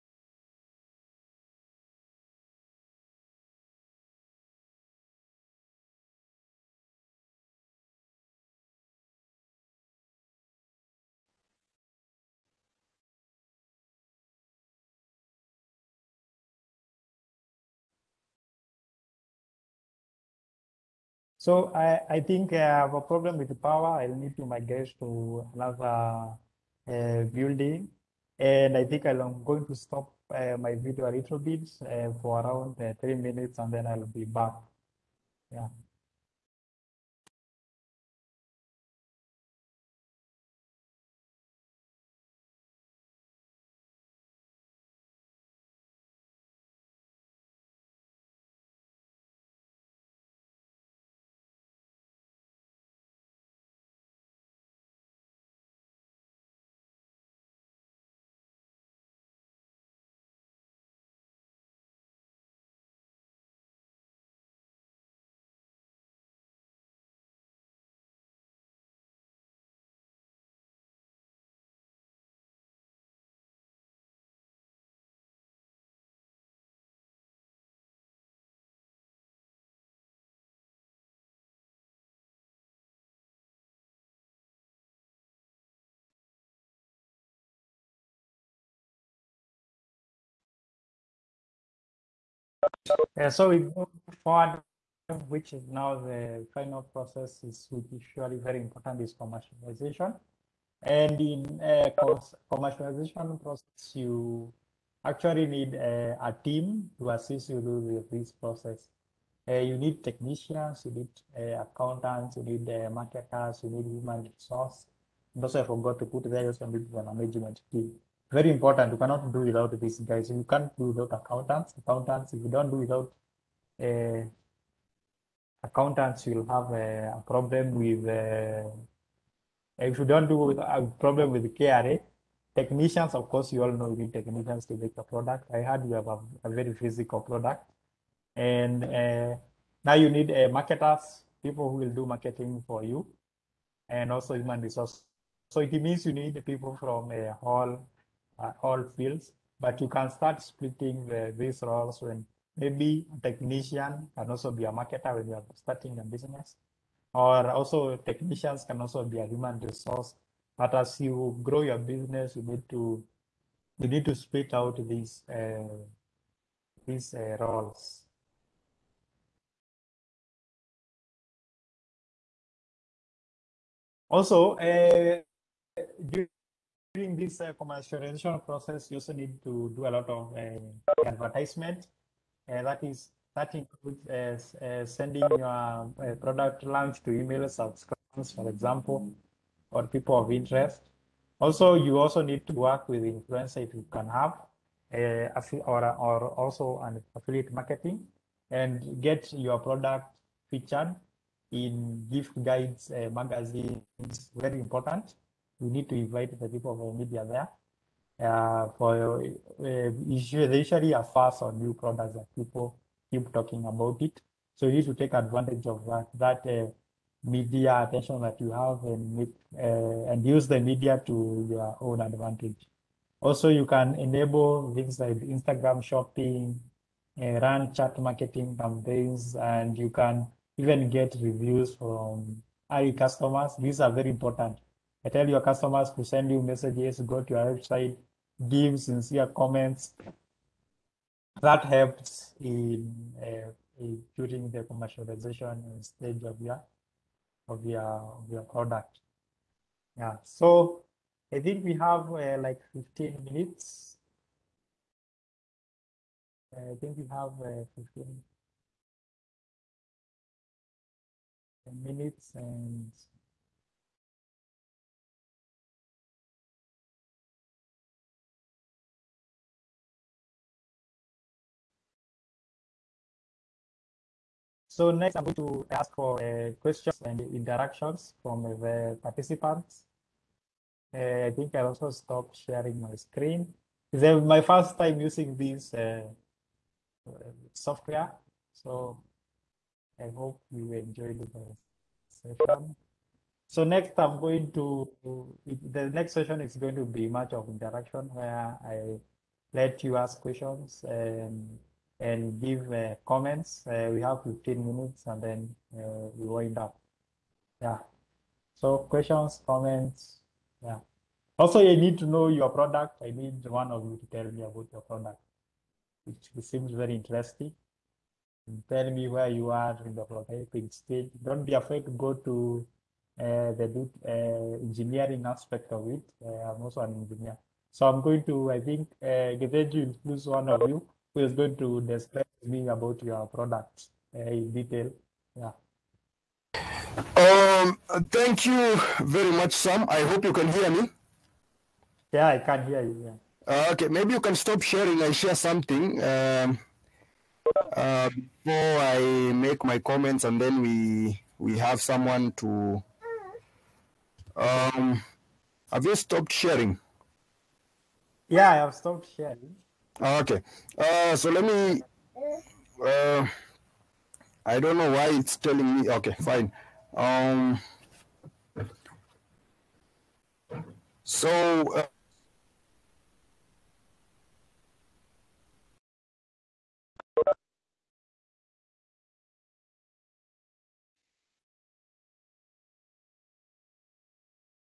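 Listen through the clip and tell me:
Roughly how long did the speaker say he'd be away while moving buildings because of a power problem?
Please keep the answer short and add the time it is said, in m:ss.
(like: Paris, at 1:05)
3 minutes, at 0:32.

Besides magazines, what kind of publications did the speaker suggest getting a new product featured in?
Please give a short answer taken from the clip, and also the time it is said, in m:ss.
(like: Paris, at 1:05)
Gift guides, at 3:22.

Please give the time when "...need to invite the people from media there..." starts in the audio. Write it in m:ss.
3:25.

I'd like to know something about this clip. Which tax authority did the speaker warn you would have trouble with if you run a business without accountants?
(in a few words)
KRA.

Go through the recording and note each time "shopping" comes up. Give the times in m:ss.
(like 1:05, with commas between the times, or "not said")
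3:45.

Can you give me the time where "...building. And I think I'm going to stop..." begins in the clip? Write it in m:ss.
0:27.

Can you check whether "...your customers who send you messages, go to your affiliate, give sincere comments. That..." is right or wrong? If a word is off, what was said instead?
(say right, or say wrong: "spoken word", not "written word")
wrong: "website", not "affiliate".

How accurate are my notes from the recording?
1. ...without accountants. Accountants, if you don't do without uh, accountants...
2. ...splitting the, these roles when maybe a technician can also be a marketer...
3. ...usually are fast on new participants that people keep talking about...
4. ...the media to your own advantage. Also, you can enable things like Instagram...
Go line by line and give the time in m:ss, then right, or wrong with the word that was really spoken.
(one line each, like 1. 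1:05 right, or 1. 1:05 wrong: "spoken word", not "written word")
1. 2:00 right
2. 2:30 right
3. 3:30 wrong: "products", not "participants"
4. 3:40 right.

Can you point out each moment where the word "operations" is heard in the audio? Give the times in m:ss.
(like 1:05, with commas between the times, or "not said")
not said.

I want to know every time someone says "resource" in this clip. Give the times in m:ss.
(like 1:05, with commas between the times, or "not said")
1:54, 2:24, 2:39.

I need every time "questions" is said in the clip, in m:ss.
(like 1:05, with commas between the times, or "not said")
4:36, 5:00, 5:08.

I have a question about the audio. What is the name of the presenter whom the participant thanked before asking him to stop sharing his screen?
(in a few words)
Sam.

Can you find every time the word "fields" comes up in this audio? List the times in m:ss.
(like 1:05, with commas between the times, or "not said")
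2:28.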